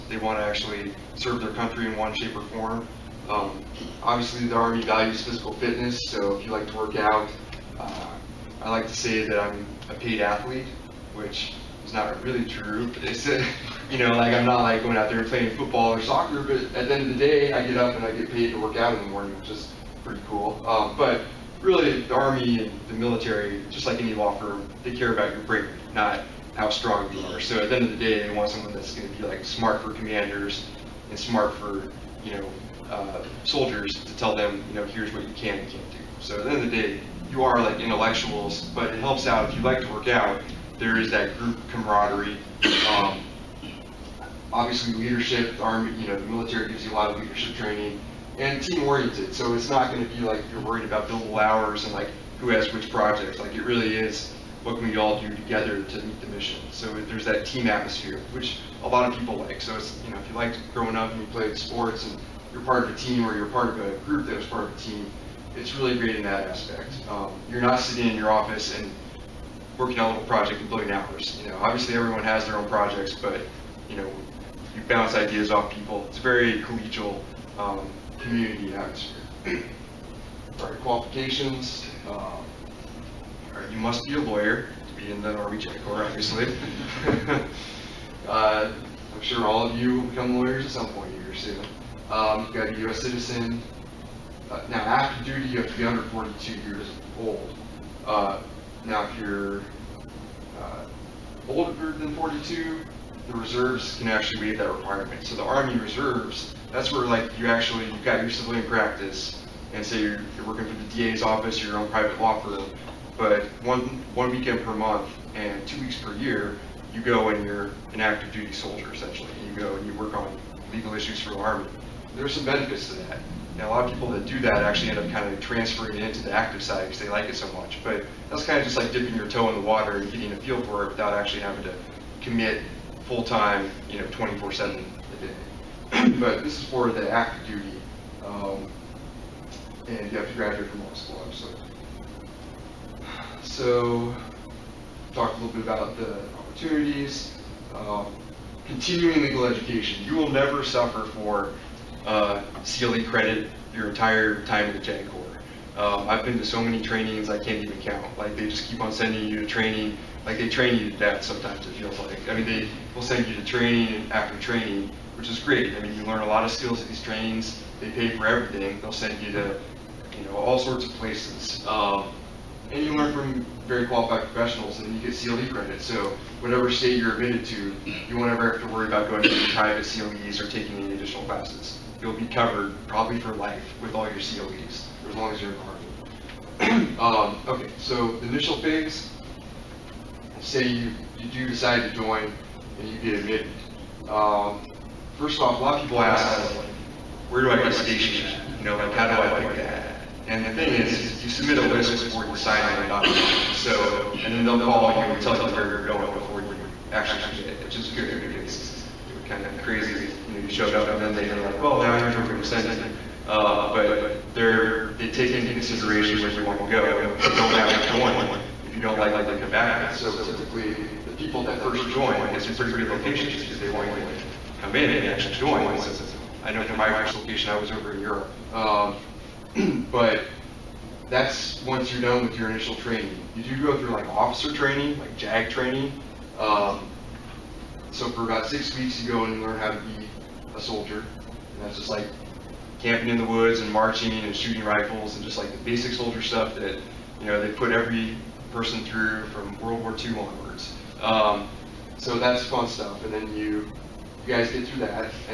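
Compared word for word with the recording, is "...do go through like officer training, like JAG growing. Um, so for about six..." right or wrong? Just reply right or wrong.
wrong.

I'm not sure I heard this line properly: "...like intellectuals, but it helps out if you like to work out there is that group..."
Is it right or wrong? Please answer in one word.
right.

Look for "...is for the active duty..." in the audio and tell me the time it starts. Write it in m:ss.
2:16.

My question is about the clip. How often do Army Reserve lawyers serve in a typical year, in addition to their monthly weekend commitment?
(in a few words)
two weeks per year.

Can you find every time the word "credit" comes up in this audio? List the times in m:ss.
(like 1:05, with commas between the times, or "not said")
2:33, 2:55.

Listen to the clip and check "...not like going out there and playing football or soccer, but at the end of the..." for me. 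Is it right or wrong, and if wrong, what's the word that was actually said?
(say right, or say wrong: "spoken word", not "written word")
right.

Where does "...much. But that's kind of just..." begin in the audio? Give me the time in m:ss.
2:07.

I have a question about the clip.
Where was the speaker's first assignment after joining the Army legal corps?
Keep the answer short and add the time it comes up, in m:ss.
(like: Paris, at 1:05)
Europe, at 3:47.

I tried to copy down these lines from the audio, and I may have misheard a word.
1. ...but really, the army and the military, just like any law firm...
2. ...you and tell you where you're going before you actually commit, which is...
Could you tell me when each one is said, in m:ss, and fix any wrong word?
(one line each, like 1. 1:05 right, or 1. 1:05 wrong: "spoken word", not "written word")
1. 0:20 right
2. 3:24 right.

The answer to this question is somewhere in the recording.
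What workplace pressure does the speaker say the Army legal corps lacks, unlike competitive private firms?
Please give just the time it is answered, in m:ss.
0:51.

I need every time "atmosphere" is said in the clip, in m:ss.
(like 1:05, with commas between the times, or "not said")
0:57, 1:18.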